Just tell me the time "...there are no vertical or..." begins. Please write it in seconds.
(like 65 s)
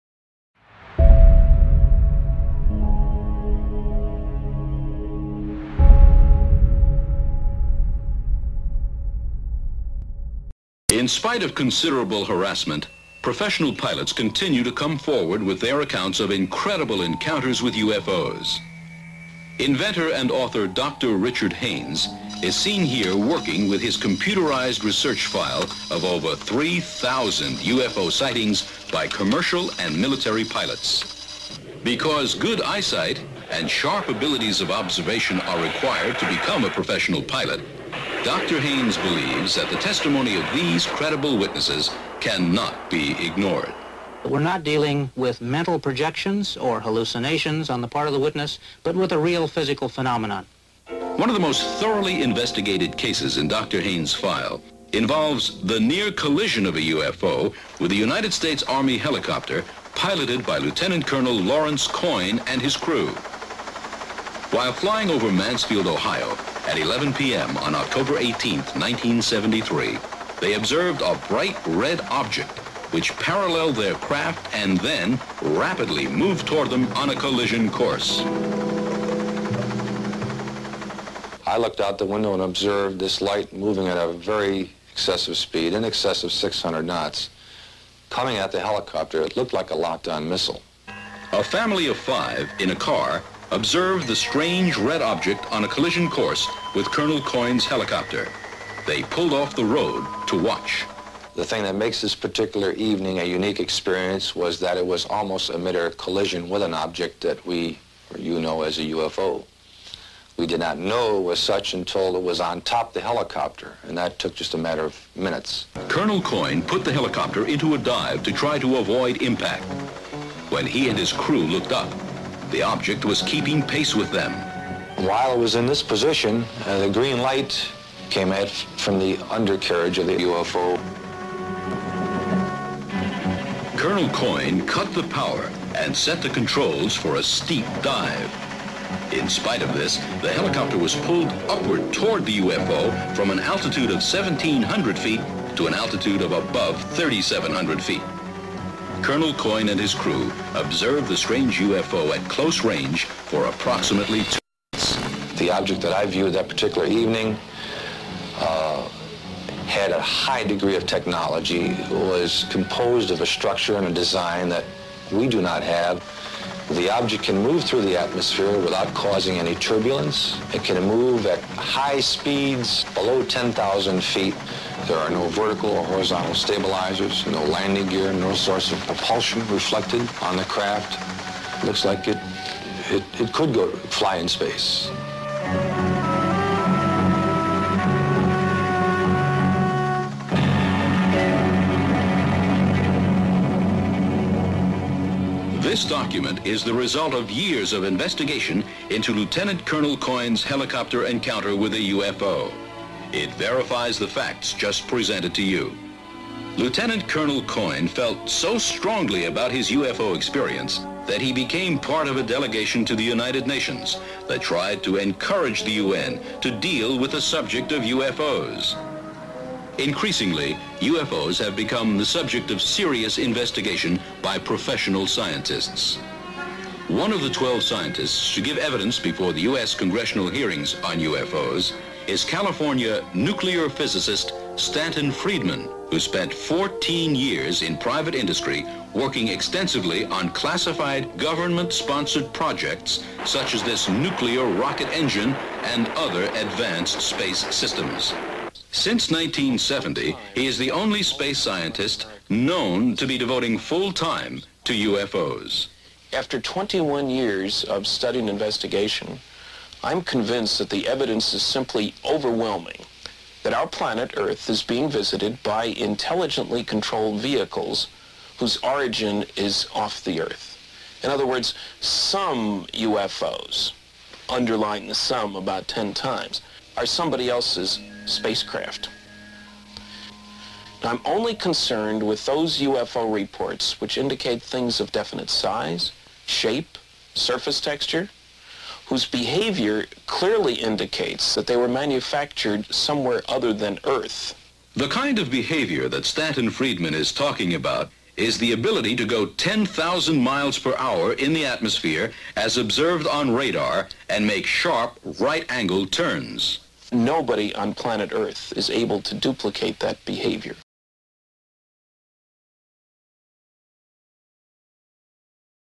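174 s.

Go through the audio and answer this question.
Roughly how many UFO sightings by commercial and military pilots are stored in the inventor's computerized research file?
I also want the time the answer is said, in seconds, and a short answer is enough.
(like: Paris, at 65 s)
over 3,000, at 26 s.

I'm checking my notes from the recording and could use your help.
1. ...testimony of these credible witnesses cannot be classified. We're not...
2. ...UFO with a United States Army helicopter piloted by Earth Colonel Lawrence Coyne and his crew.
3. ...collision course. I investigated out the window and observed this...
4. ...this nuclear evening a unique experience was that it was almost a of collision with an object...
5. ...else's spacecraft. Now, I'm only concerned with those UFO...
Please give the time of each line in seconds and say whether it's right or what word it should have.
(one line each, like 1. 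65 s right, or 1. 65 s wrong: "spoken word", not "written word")
1. 39 s wrong: "ignored", not "classified"
2. 56 s wrong: "Lieutenant", not "Earth"
3. 77 s wrong: "looked", not "investigated"
4. 102 s wrong: "particular", not "nuclear"
5. 277 s right.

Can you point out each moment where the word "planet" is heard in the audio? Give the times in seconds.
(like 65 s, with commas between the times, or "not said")
263 s, 307 s.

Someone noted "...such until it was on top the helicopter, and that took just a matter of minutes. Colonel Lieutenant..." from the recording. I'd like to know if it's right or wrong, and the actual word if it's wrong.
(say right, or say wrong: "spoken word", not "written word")
wrong: "Coyne", not "Lieutenant".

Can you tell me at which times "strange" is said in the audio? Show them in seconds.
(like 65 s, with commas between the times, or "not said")
94 s, 151 s.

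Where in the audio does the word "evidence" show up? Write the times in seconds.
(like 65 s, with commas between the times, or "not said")
228 s, 260 s.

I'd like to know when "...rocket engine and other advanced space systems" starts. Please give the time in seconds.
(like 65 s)
244 s.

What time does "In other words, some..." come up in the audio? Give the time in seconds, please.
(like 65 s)
271 s.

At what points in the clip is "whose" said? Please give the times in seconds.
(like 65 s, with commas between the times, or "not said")
268 s, 288 s.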